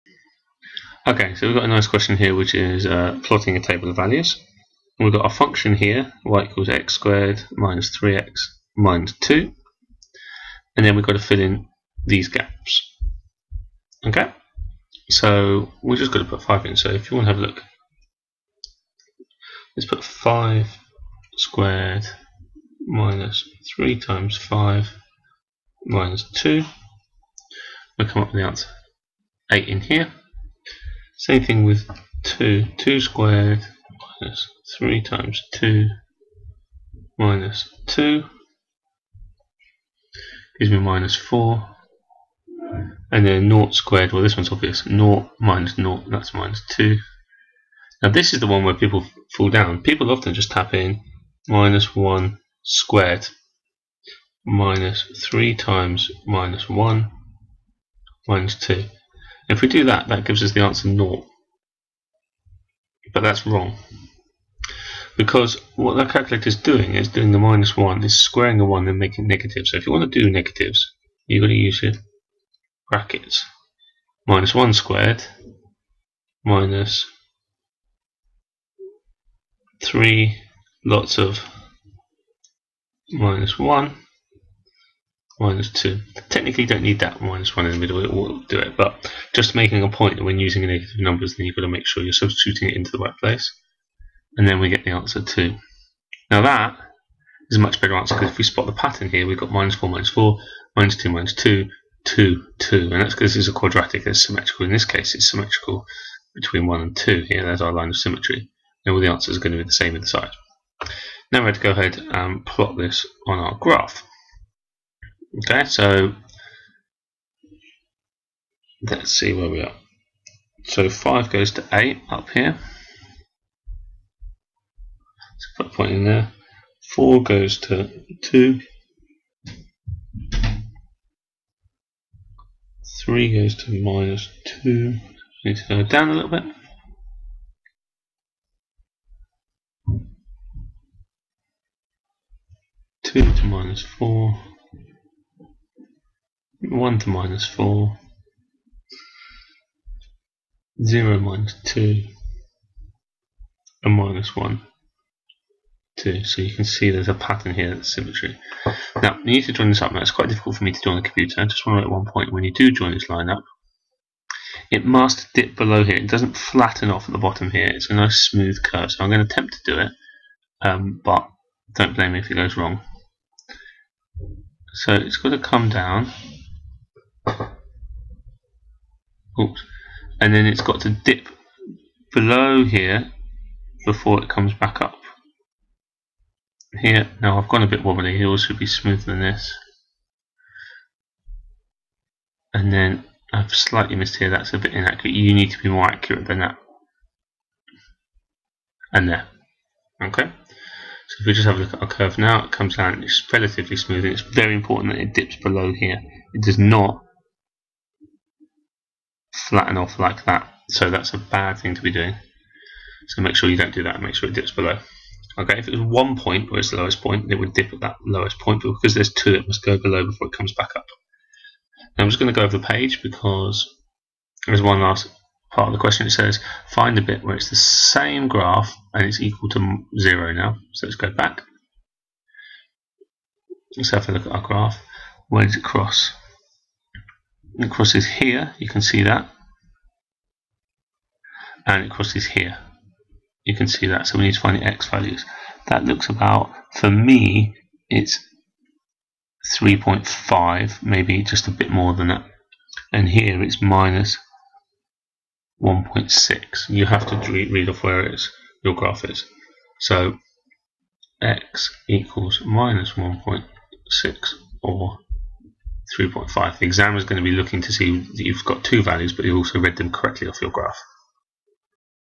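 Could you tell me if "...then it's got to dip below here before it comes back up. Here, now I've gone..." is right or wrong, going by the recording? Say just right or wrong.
right.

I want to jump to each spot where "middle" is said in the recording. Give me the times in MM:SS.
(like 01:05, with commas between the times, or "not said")
01:27.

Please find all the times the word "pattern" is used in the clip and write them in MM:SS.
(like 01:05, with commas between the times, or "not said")
01:38, 02:37.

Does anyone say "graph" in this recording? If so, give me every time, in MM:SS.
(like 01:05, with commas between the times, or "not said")
01:53, 03:48, 03:54, 04:18, 04:30.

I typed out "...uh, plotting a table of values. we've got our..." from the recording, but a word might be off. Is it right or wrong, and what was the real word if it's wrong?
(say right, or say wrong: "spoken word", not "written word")
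right.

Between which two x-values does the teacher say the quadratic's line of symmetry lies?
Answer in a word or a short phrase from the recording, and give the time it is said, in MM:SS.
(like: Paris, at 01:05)
1 and 2, at 01:46.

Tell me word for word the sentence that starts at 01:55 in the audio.
Okay, so let's see where we are.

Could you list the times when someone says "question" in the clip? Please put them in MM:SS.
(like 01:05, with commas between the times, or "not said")
00:01, 03:45.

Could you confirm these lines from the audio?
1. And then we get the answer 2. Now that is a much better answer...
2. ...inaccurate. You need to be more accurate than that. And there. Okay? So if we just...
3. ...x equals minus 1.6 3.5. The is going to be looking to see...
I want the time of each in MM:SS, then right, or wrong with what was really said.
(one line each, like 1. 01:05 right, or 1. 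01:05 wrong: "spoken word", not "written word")
1. 01:34 right
2. 03:14 right
3. 04:21 right.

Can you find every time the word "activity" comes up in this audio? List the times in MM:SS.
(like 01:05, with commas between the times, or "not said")
not said.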